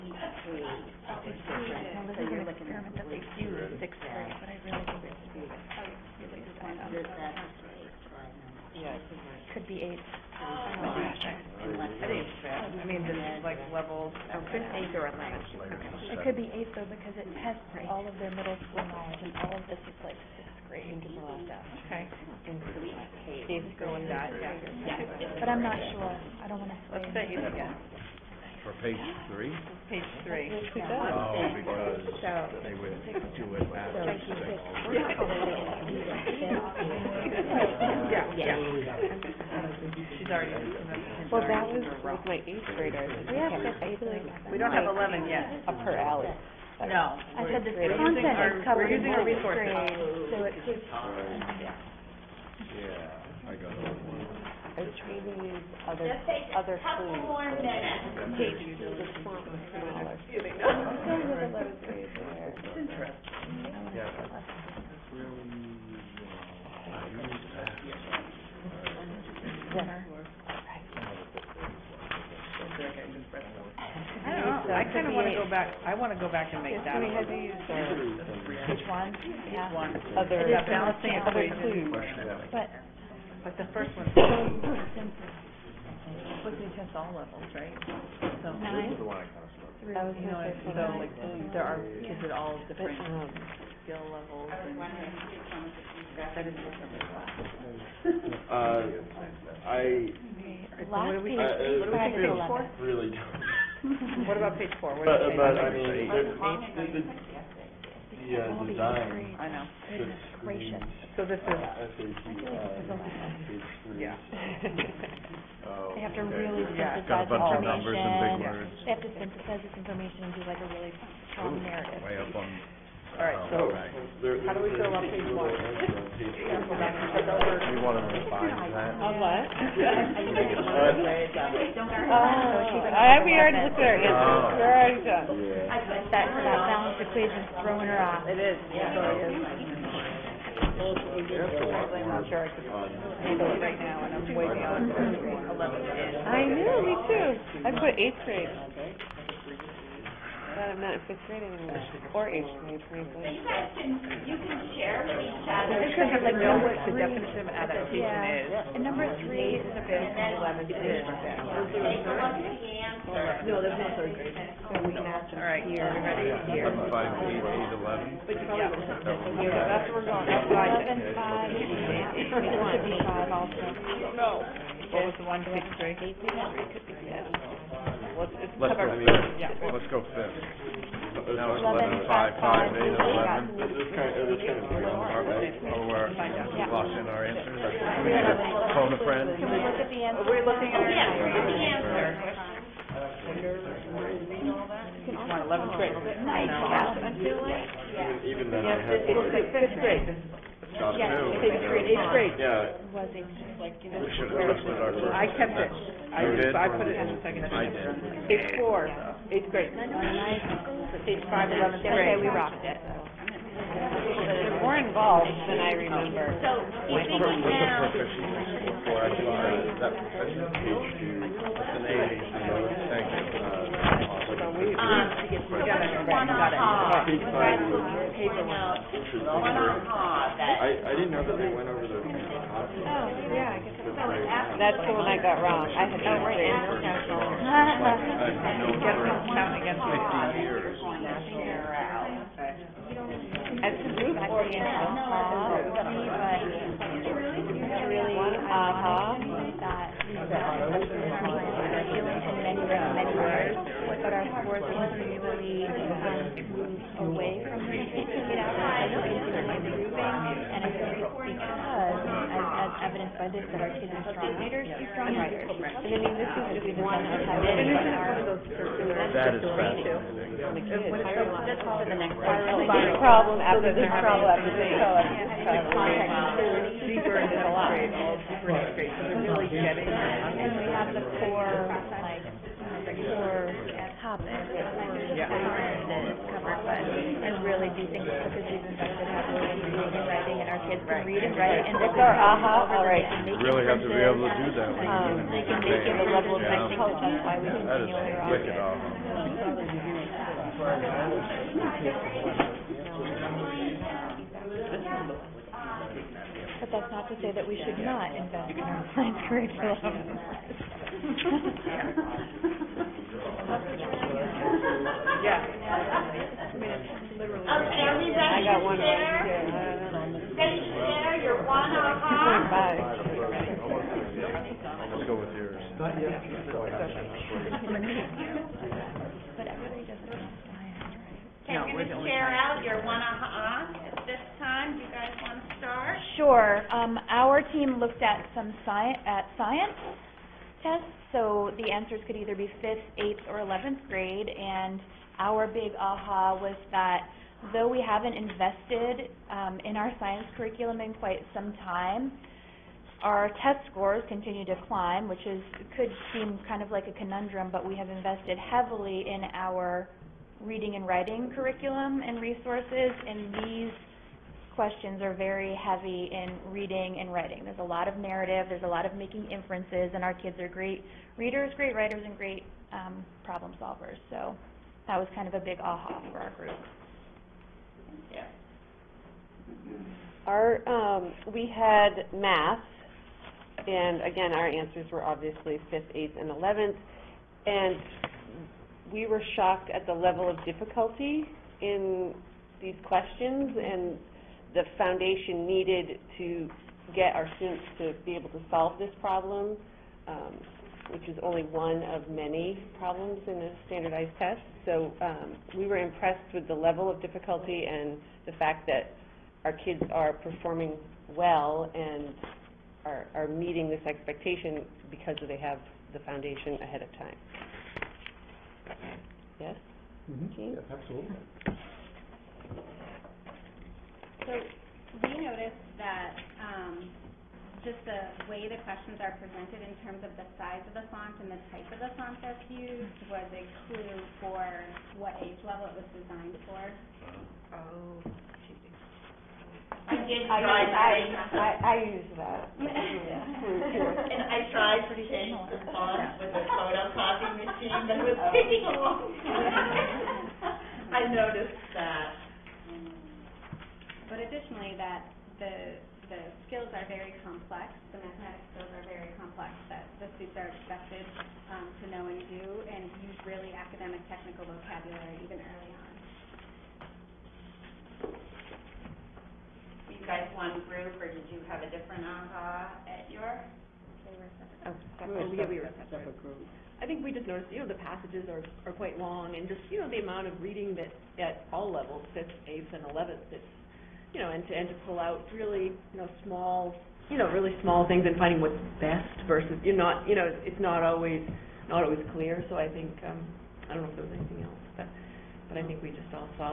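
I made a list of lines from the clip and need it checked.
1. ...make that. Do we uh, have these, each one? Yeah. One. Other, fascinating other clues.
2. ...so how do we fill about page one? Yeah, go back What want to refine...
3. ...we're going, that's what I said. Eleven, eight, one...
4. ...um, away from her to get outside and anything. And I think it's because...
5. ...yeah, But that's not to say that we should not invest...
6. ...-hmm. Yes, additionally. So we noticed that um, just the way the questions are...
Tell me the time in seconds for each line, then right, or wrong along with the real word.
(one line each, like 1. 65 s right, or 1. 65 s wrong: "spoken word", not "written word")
1. 76 s wrong: "balancing", not "fascinating"
2. 123 s wrong: "You", not "What"
3. 170 s wrong: "five", not "eight"
4. 255 s wrong: "moving", not "anything"
5. 304 s right
6. 420 s wrong: "absolutely", not "additionally".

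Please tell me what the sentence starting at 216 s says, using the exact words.
So, you What's the now, I that- Um, to get so together.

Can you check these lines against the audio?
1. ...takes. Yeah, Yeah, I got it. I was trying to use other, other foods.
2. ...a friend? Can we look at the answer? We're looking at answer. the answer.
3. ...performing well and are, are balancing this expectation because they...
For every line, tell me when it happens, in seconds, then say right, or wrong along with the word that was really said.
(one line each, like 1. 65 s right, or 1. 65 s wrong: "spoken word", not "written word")
1. 50 s right
2. 188 s right
3. 410 s wrong: "meeting", not "balancing".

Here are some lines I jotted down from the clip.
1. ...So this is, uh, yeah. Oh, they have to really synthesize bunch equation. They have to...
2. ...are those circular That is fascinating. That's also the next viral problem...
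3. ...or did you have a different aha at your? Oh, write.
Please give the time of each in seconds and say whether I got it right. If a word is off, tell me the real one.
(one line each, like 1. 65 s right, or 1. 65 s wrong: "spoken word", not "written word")
1. 111 s wrong: "information", not "equation"
2. 267 s right
3. 470 s wrong: "separate", not "write".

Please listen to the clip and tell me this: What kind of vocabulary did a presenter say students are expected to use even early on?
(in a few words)
academic technical vocabulary.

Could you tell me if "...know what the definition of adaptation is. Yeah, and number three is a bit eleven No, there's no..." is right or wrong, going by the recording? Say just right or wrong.
right.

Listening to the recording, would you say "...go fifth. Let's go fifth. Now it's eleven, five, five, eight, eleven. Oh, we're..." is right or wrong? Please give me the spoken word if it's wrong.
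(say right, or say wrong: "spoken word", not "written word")
right.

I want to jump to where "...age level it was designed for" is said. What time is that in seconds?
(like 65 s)
435 s.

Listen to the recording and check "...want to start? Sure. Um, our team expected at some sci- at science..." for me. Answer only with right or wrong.
wrong.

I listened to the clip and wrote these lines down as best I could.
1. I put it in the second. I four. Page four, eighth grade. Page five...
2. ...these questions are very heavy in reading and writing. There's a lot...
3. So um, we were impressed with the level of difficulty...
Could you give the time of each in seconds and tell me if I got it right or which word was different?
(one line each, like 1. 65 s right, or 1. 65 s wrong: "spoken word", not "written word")
1. 206 s right
2. 363 s right
3. 404 s right.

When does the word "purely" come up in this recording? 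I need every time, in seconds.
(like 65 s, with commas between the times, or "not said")
not said.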